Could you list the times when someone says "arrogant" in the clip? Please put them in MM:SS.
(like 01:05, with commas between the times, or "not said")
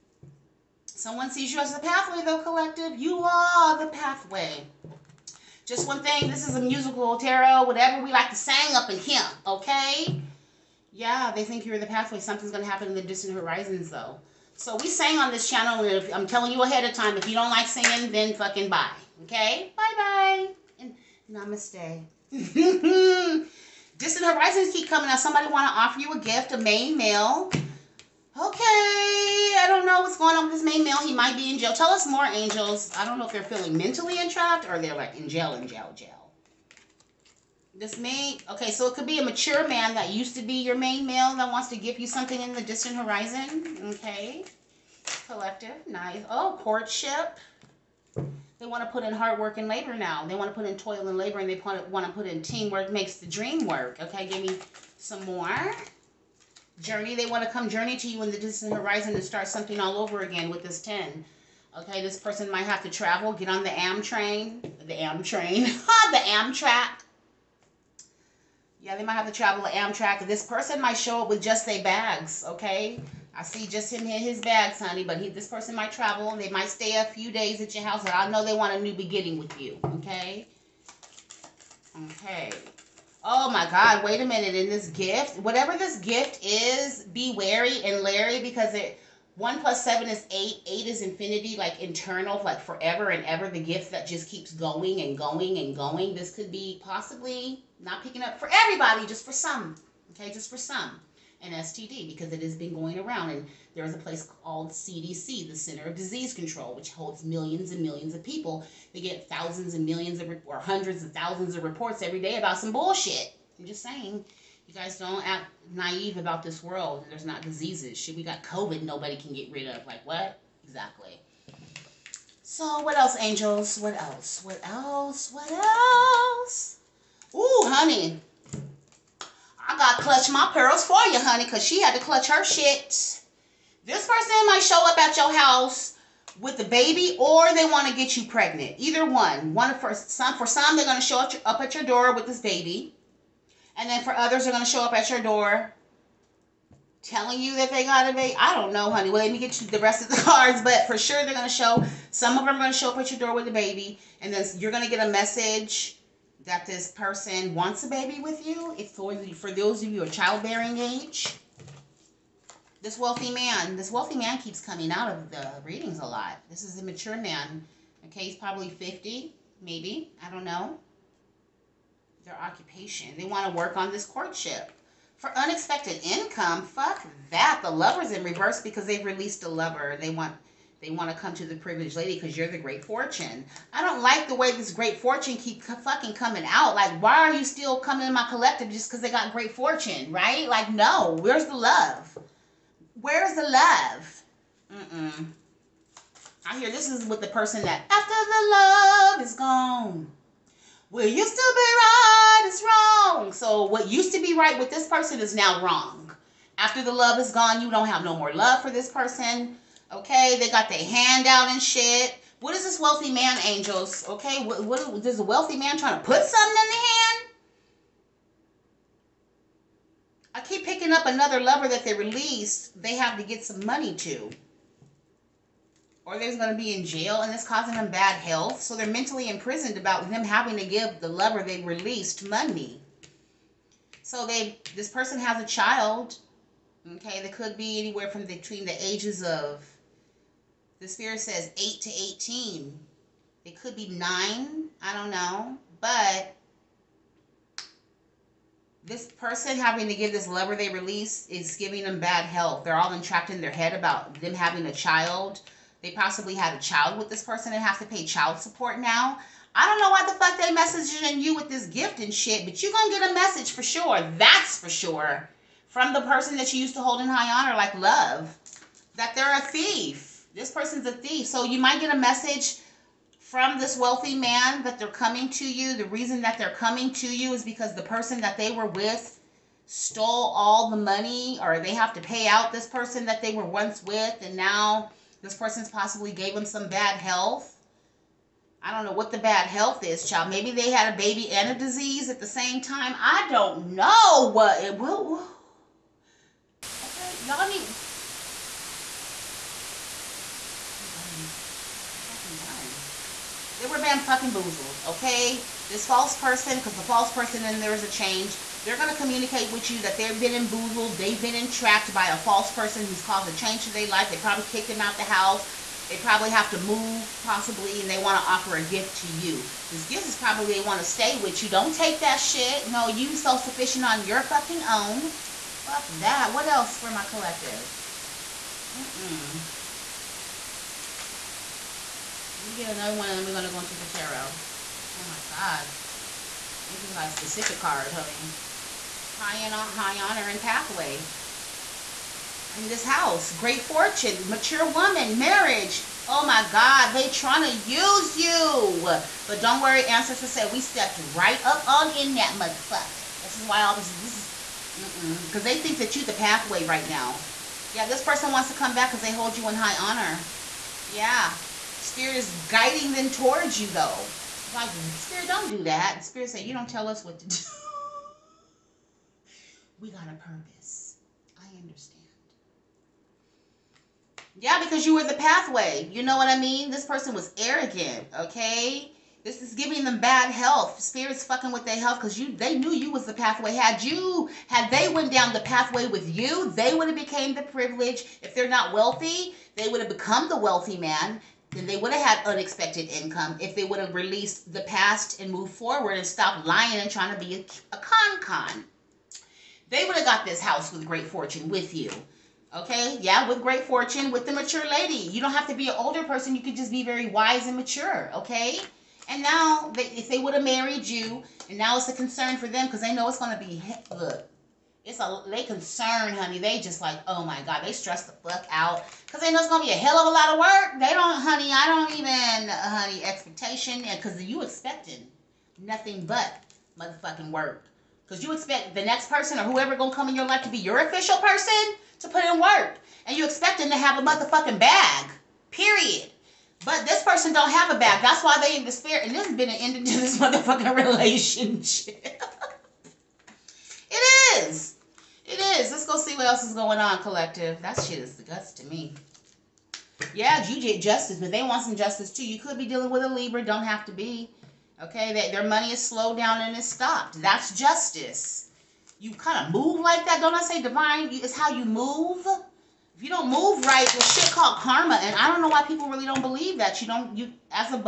06:17.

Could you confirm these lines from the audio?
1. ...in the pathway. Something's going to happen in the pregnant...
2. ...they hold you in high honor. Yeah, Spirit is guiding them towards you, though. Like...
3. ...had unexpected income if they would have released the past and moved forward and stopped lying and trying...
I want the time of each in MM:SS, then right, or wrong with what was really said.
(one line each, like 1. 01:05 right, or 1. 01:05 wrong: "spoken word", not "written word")
1. 00:11 wrong: "distant", not "pregnant"
2. 05:59 right
3. 06:32 right.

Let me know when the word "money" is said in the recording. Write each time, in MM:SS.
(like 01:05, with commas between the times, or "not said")
03:43, 03:52, 04:40, 07:35.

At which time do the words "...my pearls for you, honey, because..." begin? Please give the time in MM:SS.
02:10.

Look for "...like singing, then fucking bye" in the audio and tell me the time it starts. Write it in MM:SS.
00:17.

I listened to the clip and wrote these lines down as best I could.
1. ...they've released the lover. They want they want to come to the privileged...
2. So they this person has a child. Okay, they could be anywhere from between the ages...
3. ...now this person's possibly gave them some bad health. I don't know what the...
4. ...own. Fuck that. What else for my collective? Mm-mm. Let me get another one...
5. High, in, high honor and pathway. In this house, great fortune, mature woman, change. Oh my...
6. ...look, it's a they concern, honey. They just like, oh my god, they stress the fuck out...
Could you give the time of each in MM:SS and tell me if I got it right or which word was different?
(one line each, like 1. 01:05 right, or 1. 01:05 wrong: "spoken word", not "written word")
1. 02:58 right
2. 03:54 right
3. 04:44 right
4. 05:24 right
5. 05:39 wrong: "marriage", not "change"
6. 06:53 right.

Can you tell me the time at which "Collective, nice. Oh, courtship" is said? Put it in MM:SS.
00:45.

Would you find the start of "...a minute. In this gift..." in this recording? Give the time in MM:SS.
01:24.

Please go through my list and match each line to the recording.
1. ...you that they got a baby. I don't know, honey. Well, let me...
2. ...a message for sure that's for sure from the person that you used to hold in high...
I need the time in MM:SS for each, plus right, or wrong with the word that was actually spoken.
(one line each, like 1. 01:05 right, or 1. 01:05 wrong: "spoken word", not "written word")
1. 02:27 right
2. 04:23 right.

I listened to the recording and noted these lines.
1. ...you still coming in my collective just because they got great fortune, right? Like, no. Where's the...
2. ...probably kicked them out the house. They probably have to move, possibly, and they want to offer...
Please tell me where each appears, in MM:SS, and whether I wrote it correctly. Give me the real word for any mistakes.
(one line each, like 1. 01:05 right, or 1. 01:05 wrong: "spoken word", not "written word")
1. 03:07 right
2. 05:14 right.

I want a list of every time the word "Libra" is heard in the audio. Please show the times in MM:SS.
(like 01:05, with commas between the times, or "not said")
07:33.